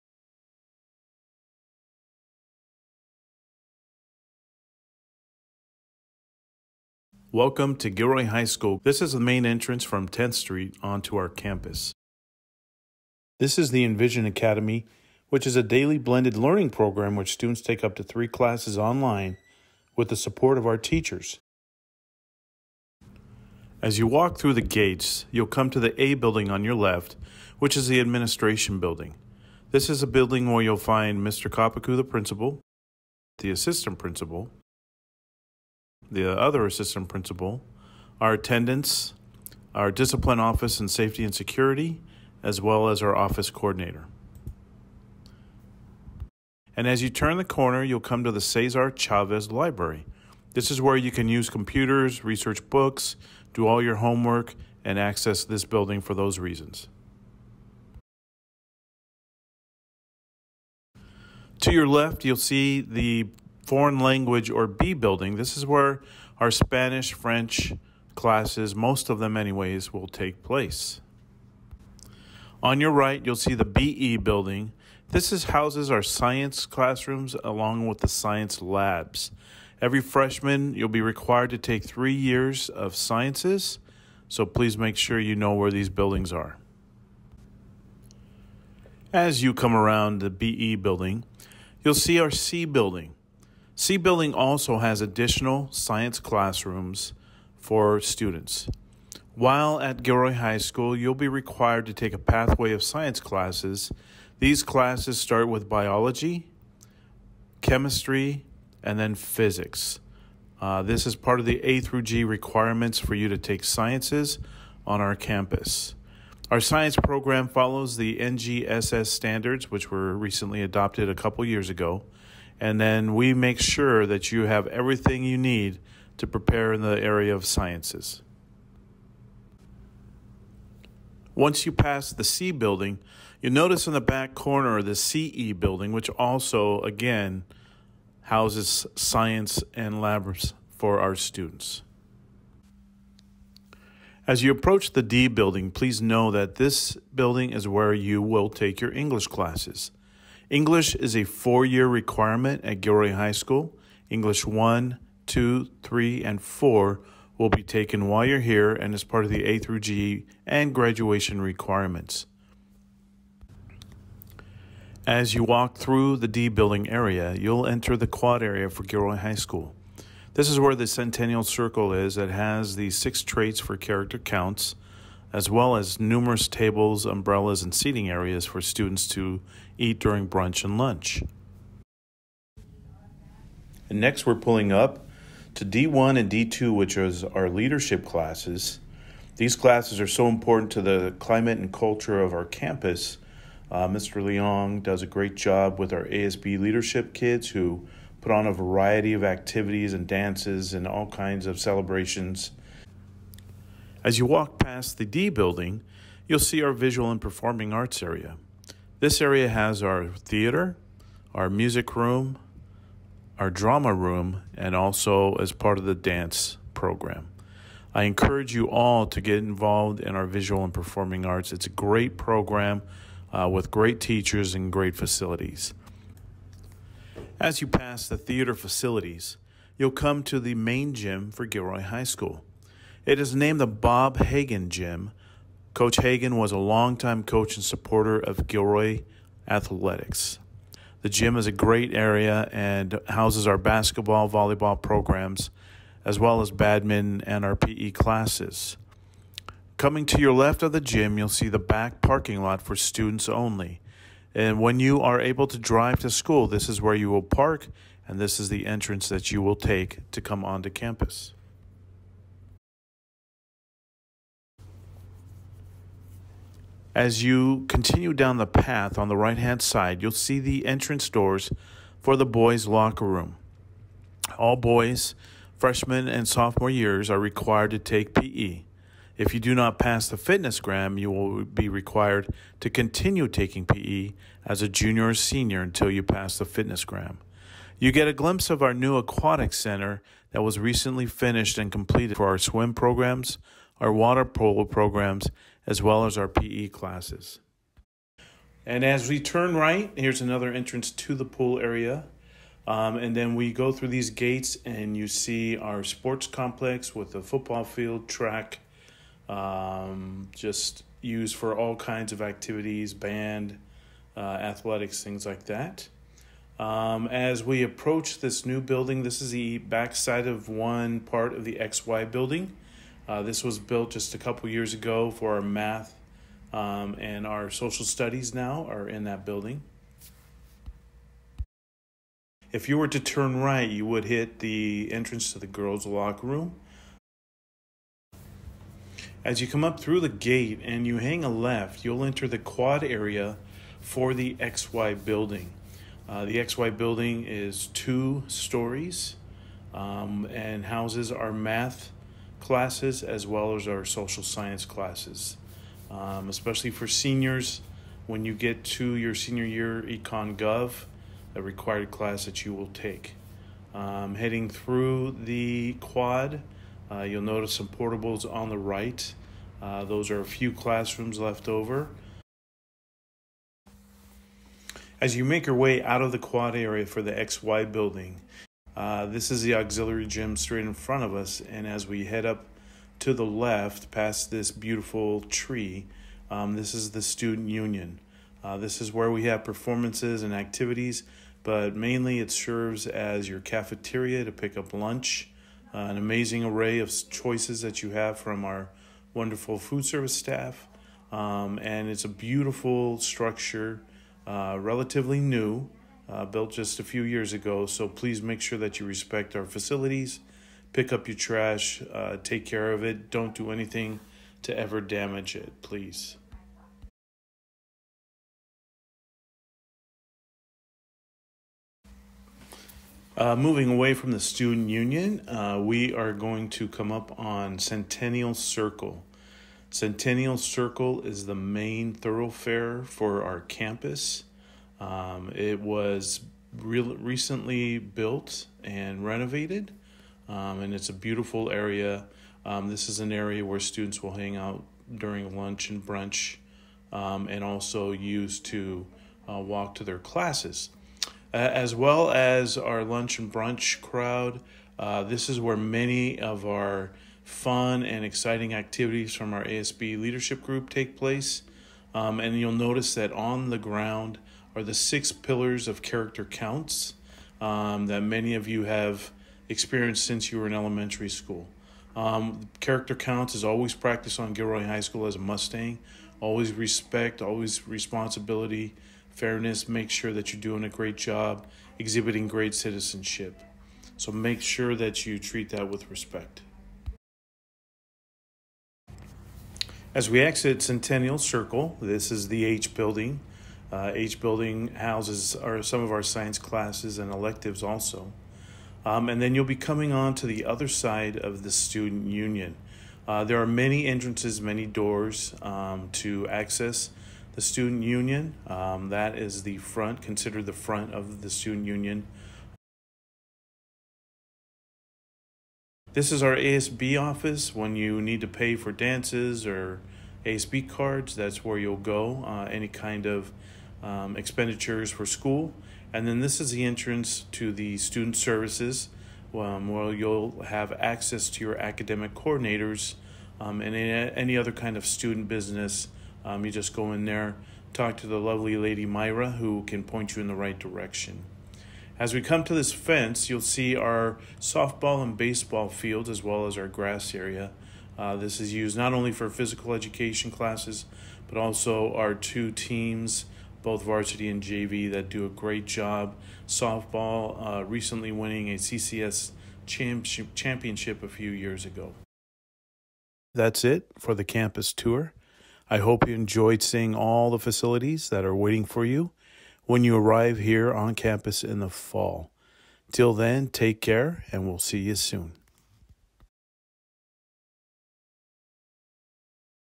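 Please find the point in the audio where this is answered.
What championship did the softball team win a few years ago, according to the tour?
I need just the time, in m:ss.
9:18.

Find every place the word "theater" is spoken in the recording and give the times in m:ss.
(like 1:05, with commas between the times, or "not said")
3:30, 3:48.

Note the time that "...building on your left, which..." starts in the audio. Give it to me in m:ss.
0:26.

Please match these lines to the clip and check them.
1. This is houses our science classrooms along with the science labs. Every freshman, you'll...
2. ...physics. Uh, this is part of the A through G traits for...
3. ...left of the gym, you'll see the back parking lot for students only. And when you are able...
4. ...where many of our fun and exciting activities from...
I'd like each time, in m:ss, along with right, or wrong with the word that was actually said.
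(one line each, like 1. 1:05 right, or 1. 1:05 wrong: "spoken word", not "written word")
1. 1:15 right
2. 1:49 wrong: "requirements", not "traits"
3. 4:10 right
4. 7:35 right.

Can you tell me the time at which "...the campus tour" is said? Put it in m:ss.
9:24.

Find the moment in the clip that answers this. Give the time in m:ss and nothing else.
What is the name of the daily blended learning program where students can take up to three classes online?
0:13.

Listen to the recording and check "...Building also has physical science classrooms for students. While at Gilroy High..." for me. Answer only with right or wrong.
wrong.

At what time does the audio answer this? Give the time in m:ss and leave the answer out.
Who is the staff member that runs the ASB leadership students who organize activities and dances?
3:13.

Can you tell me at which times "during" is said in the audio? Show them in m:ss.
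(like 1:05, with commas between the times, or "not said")
2:59, 7:24.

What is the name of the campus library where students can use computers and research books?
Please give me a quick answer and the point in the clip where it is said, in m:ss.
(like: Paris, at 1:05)
Cesar Chavez Library, at 0:48.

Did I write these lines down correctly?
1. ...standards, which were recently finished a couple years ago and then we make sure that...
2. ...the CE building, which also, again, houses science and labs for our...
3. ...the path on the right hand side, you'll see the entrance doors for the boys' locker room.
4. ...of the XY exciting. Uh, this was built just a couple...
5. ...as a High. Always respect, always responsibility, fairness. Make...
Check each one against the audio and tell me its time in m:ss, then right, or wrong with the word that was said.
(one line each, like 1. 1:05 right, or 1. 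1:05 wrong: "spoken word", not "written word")
1. 1:59 wrong: "adopted", not "finished"
2. 2:14 right
3. 4:28 right
4. 5:21 wrong: "building", not "exciting"
5. 7:55 wrong: "Mustang", not "High".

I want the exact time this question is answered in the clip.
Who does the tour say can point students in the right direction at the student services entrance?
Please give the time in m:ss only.
8:58.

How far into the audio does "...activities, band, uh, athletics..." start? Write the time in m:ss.
5:12.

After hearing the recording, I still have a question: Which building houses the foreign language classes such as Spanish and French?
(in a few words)
B building.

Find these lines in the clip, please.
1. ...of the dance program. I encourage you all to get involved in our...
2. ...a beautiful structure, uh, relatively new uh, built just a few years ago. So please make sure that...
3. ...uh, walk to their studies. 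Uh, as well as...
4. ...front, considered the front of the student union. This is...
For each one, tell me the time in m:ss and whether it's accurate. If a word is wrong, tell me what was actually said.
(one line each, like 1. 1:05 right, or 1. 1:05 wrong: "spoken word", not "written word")
1. 3:35 right
2. 6:42 right
3. 7:29 wrong: "classes", not "studies"
4. 8:29 right.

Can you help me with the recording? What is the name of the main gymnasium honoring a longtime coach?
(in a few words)
Bob Hagan Gym.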